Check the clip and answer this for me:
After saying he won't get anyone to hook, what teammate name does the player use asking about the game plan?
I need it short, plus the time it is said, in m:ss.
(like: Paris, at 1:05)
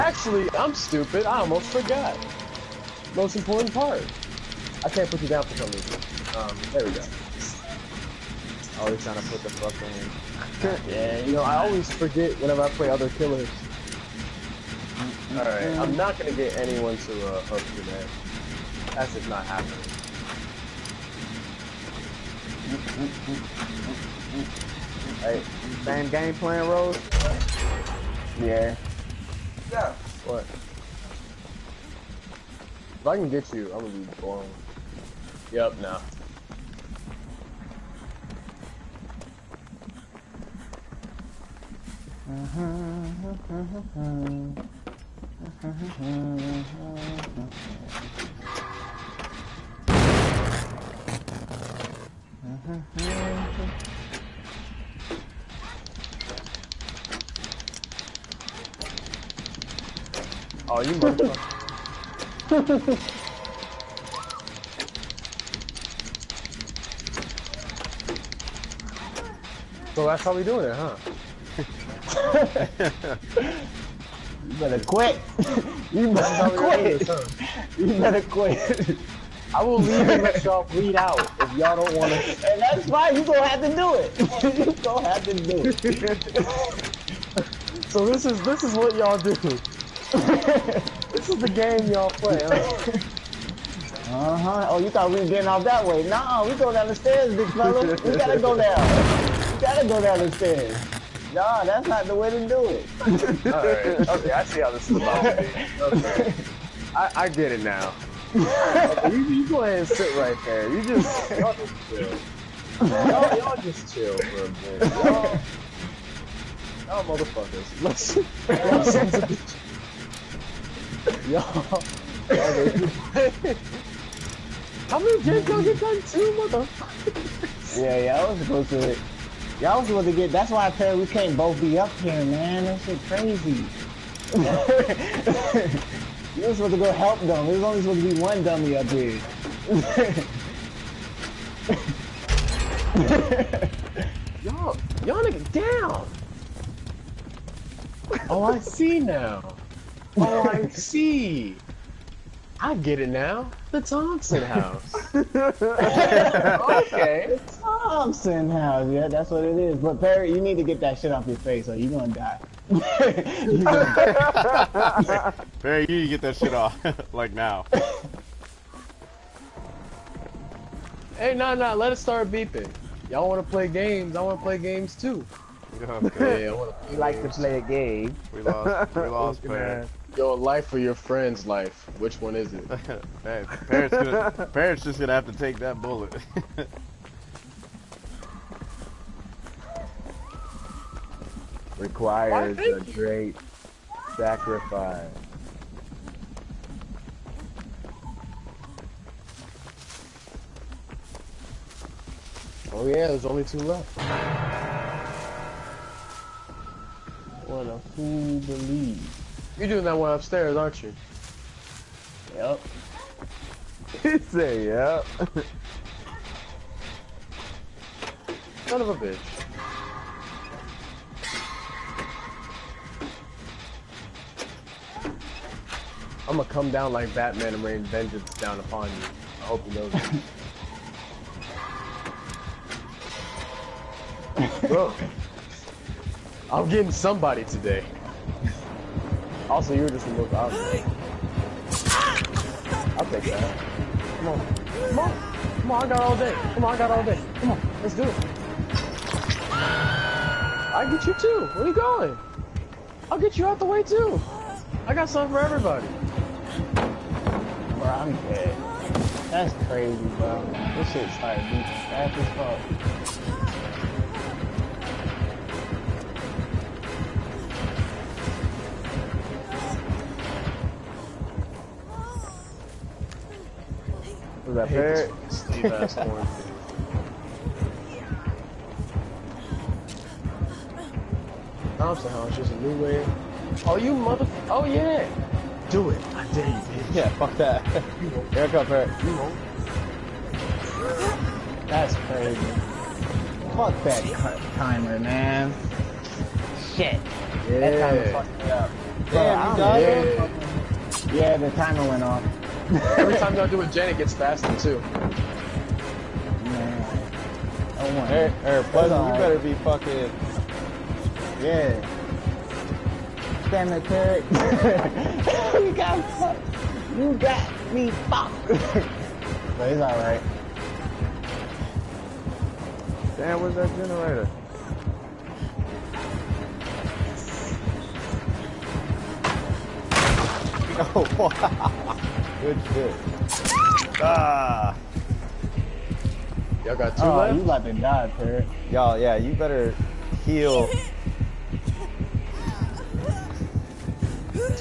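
Rose, at 0:26.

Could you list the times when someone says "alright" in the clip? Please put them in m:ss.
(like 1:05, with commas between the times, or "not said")
0:15, 5:19.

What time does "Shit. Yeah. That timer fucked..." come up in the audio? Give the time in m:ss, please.
4:56.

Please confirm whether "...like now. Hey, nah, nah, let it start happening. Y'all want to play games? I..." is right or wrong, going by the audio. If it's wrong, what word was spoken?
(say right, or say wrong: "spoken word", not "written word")
wrong: "beeping", not "happening".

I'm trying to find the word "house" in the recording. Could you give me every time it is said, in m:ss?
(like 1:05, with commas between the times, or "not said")
2:34, 2:38, 4:42.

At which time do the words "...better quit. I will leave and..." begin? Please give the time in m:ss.
1:17.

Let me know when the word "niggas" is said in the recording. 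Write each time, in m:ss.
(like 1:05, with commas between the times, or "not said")
2:25.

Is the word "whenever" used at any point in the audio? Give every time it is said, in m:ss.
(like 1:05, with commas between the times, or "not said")
0:12.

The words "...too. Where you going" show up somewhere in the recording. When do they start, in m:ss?
4:11.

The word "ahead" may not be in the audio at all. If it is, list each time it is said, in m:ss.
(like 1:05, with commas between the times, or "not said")
1:49.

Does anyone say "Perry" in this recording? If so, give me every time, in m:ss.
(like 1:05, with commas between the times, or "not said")
2:39, 5:38.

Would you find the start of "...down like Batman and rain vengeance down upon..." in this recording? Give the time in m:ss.
3:46.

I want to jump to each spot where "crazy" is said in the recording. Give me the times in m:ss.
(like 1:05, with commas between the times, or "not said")
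2:13, 4:19, 4:51.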